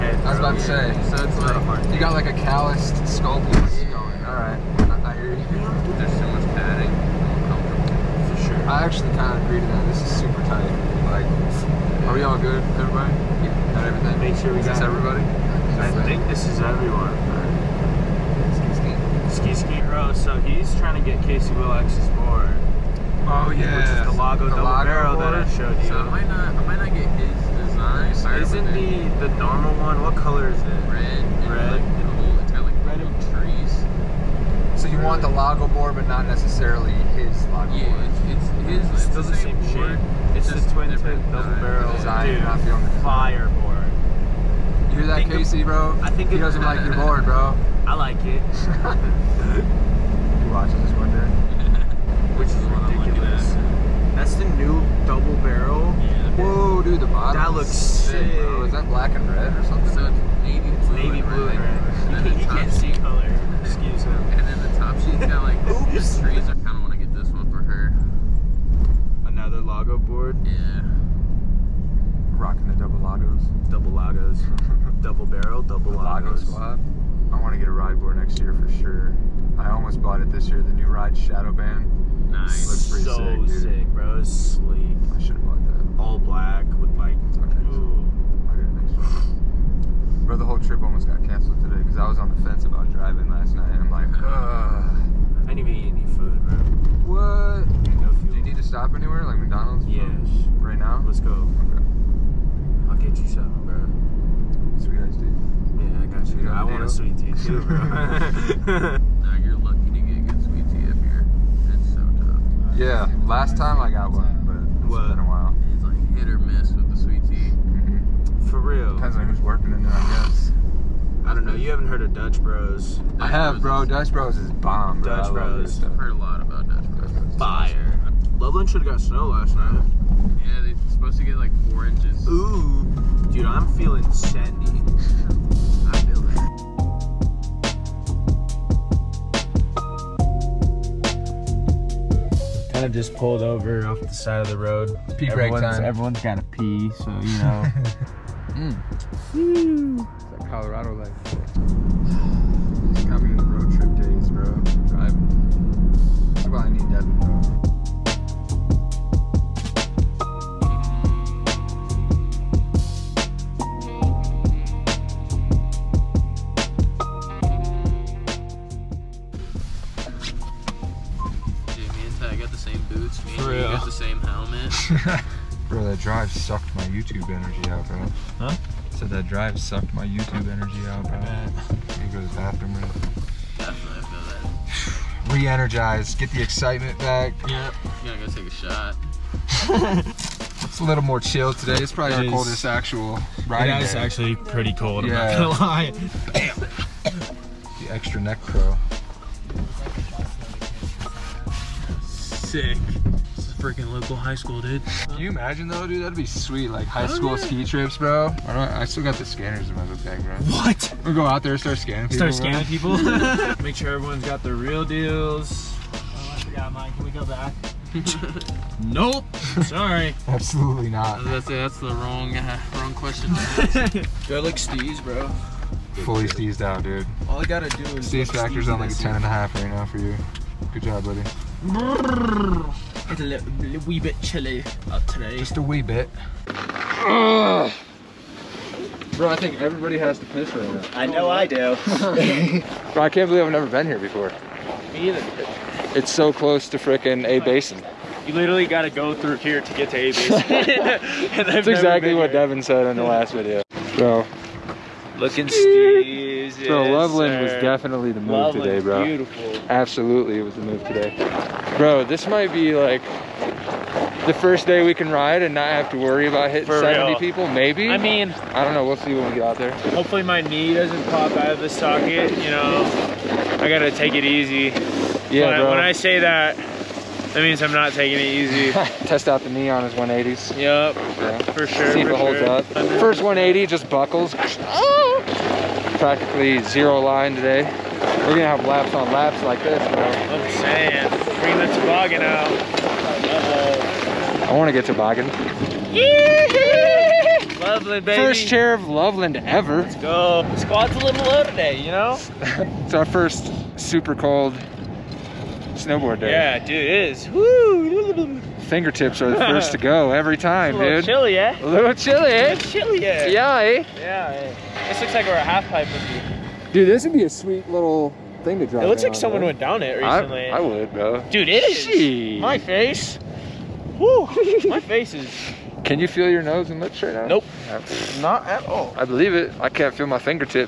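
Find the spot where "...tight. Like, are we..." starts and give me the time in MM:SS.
00:10.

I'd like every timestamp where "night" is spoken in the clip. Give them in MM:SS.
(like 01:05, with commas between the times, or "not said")
01:33, 02:09.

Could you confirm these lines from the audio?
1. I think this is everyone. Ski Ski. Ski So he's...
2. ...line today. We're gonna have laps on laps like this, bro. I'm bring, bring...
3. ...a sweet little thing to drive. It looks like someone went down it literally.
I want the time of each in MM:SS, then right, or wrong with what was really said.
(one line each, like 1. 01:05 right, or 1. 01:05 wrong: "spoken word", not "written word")
1. 00:15 right
2. 04:46 wrong: "saying", not "bring"
3. 05:17 wrong: "recently", not "literally".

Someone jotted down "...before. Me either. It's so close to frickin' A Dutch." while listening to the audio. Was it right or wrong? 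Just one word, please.
wrong.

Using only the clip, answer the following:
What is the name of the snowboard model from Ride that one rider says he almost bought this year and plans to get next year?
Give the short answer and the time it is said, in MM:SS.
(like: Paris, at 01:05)
Shadowban, at 01:21.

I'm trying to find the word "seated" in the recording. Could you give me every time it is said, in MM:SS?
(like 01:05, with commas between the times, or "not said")
not said.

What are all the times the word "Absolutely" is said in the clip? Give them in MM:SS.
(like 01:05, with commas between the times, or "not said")
03:40, 04:19.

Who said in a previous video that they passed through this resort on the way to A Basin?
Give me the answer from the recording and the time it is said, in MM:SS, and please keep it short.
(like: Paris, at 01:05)
Devin, at 04:12.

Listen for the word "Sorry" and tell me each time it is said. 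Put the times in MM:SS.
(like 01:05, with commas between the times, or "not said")
00:28, 03:39.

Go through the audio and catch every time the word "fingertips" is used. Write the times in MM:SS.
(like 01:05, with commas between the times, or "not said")
05:08, 05:30.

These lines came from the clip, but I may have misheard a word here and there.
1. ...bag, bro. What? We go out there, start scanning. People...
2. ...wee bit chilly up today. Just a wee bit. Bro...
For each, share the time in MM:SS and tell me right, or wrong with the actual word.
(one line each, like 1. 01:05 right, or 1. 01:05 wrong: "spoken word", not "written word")
1. 03:30 right
2. 03:53 right.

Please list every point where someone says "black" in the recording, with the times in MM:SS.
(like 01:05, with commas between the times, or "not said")
00:58, 01:26.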